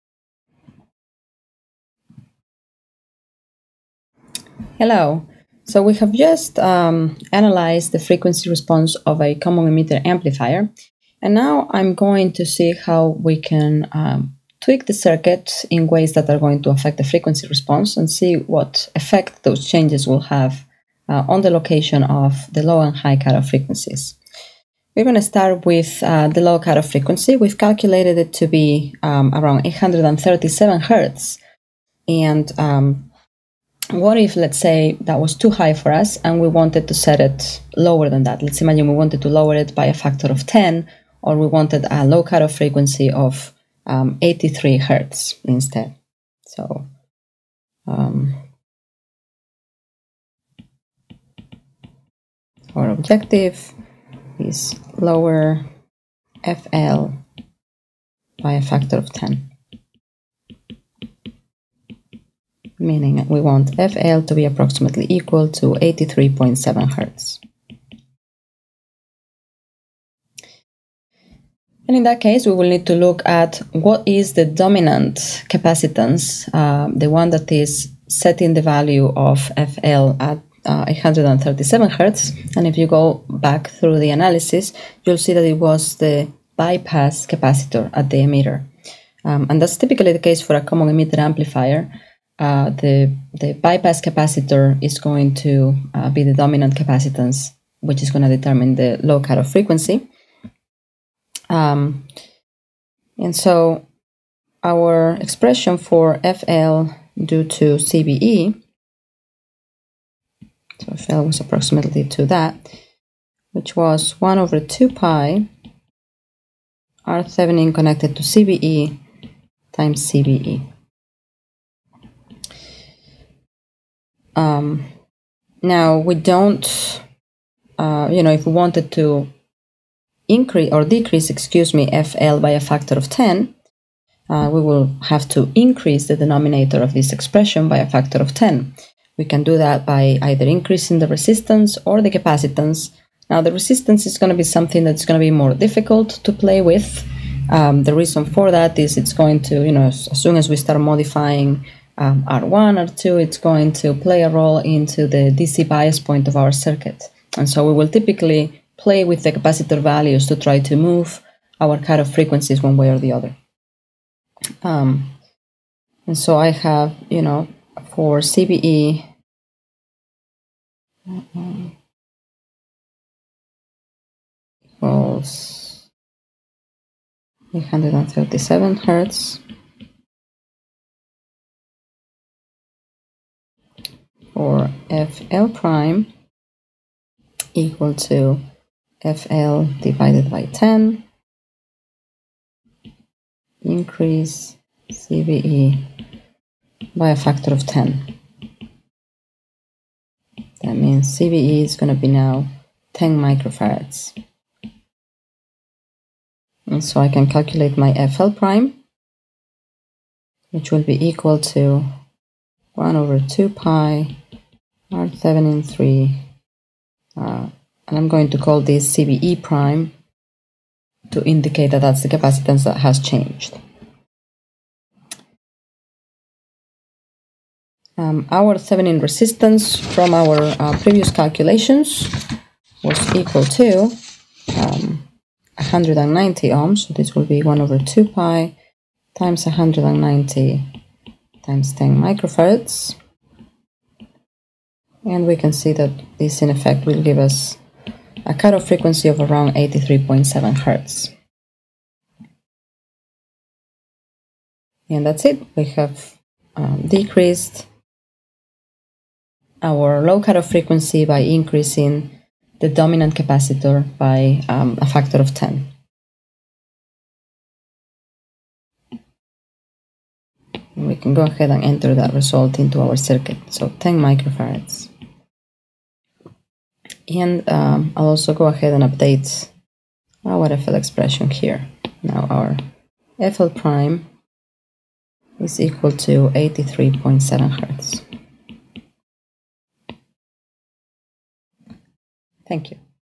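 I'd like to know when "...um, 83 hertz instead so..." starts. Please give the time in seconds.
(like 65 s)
43 s.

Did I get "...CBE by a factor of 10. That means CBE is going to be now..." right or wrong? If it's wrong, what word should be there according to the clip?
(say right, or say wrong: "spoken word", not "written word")
right.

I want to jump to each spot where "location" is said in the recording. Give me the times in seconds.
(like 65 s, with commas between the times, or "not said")
21 s.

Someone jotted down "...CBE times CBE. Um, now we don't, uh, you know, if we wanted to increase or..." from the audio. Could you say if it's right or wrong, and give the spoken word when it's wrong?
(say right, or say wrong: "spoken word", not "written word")
right.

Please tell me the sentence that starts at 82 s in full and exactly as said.
And if you go back through the analysis, you'll see that it was the bypass capacitor at the emitter.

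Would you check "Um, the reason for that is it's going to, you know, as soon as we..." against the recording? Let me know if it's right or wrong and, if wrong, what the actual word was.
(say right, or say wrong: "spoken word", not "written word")
right.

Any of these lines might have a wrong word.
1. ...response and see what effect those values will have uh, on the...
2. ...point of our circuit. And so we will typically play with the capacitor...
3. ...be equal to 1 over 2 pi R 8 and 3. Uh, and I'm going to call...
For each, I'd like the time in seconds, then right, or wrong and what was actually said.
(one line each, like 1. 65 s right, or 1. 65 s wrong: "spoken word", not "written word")
1. 17 s wrong: "changes", not "values"
2. 155 s right
3. 210 s wrong: "7", not "8".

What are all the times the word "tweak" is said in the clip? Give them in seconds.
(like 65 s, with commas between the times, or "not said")
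14 s.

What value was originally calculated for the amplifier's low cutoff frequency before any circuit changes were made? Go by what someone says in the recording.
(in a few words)
837 Hz.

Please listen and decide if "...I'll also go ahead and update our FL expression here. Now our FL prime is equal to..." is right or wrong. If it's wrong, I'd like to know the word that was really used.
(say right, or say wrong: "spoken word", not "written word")
right.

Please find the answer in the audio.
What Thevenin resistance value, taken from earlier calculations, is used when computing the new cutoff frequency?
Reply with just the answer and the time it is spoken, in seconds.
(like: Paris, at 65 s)
190 ohms, at 235 s.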